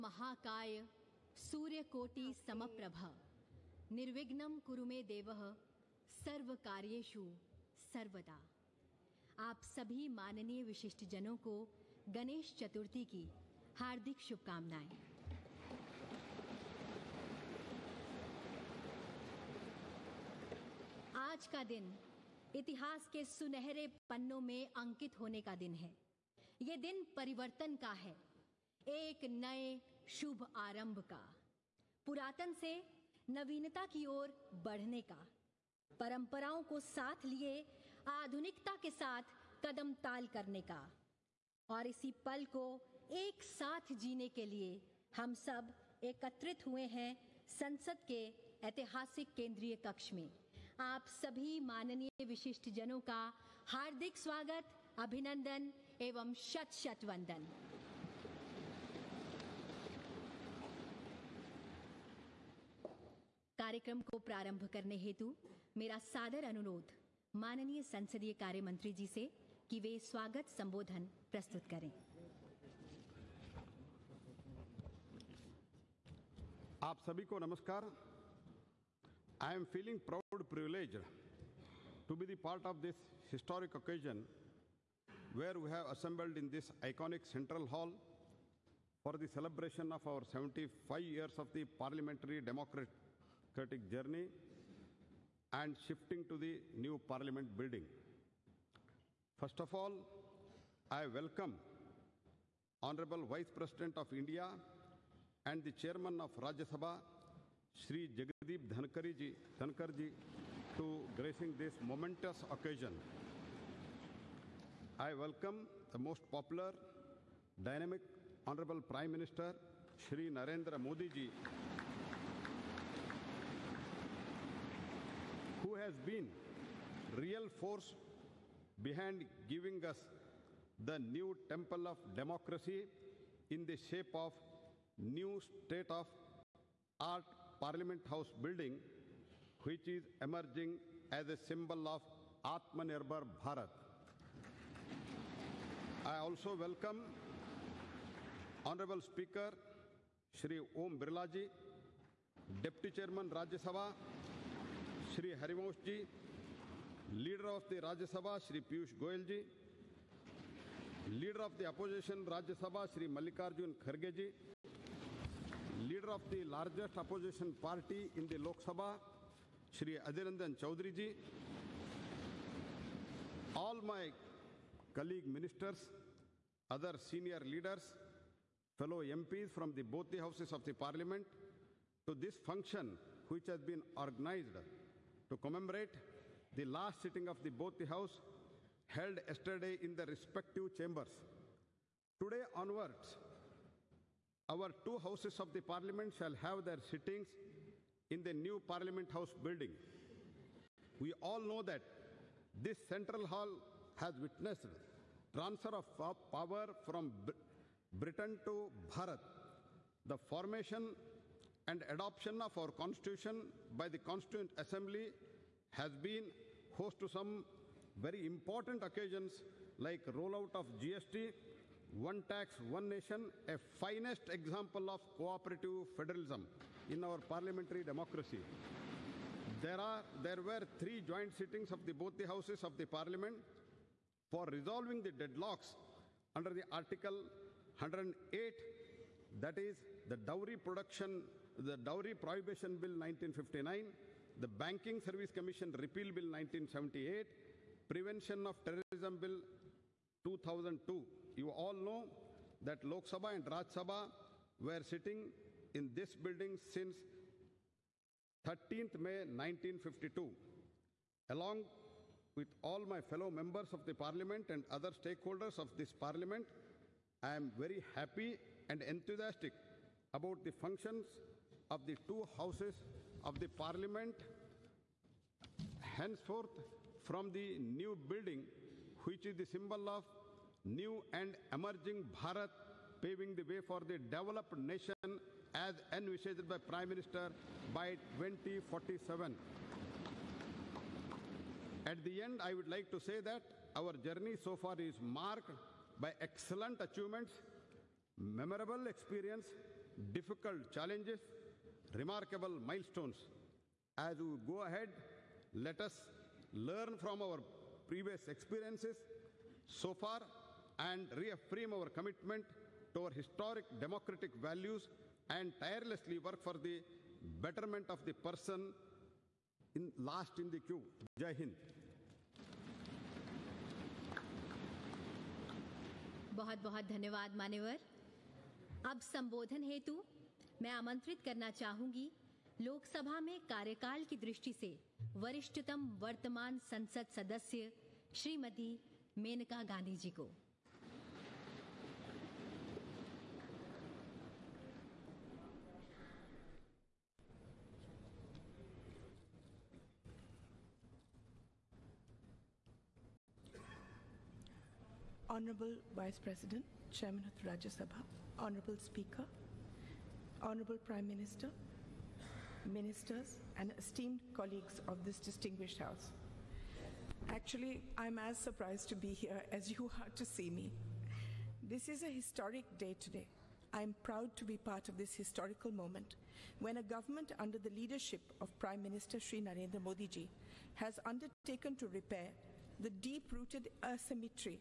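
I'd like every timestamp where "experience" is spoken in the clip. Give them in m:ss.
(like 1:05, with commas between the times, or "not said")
4:58, 5:08.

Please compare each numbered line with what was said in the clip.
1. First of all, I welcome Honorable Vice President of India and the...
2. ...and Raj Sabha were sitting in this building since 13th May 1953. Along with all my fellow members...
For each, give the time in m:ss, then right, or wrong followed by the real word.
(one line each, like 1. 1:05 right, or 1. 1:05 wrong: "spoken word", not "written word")
1. 1:39 right
2. 4:13 wrong: "1952", not "1953".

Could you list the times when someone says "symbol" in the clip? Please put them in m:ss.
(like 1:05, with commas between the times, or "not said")
2:21, 4:39.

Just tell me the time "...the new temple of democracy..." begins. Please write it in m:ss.
2:10.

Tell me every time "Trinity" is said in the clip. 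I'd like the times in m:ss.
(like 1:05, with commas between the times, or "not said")
not said.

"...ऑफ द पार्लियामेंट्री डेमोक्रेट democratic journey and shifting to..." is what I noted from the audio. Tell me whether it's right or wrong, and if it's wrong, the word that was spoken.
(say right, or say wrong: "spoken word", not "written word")
right.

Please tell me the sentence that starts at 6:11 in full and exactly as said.
This is a historic day today.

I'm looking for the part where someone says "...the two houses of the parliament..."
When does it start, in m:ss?
4:31.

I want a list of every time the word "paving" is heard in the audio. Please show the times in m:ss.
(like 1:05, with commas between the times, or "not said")
4:43.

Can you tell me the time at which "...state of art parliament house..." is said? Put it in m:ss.
2:15.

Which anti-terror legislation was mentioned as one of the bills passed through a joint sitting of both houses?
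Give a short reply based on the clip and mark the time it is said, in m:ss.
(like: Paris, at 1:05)
Prevention of Terrorism Bill 2002, at 4:07.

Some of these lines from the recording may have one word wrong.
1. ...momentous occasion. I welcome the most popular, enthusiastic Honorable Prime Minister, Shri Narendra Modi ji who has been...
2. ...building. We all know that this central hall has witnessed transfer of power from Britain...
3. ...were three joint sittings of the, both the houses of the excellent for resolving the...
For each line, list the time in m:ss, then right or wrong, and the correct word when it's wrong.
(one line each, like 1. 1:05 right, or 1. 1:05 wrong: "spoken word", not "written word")
1. 1:51 wrong: "dynamic", not "enthusiastic"
2. 3:19 right
3. 3:50 wrong: "parliament", not "excellent".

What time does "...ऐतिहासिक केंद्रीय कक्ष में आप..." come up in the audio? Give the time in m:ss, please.
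0:48.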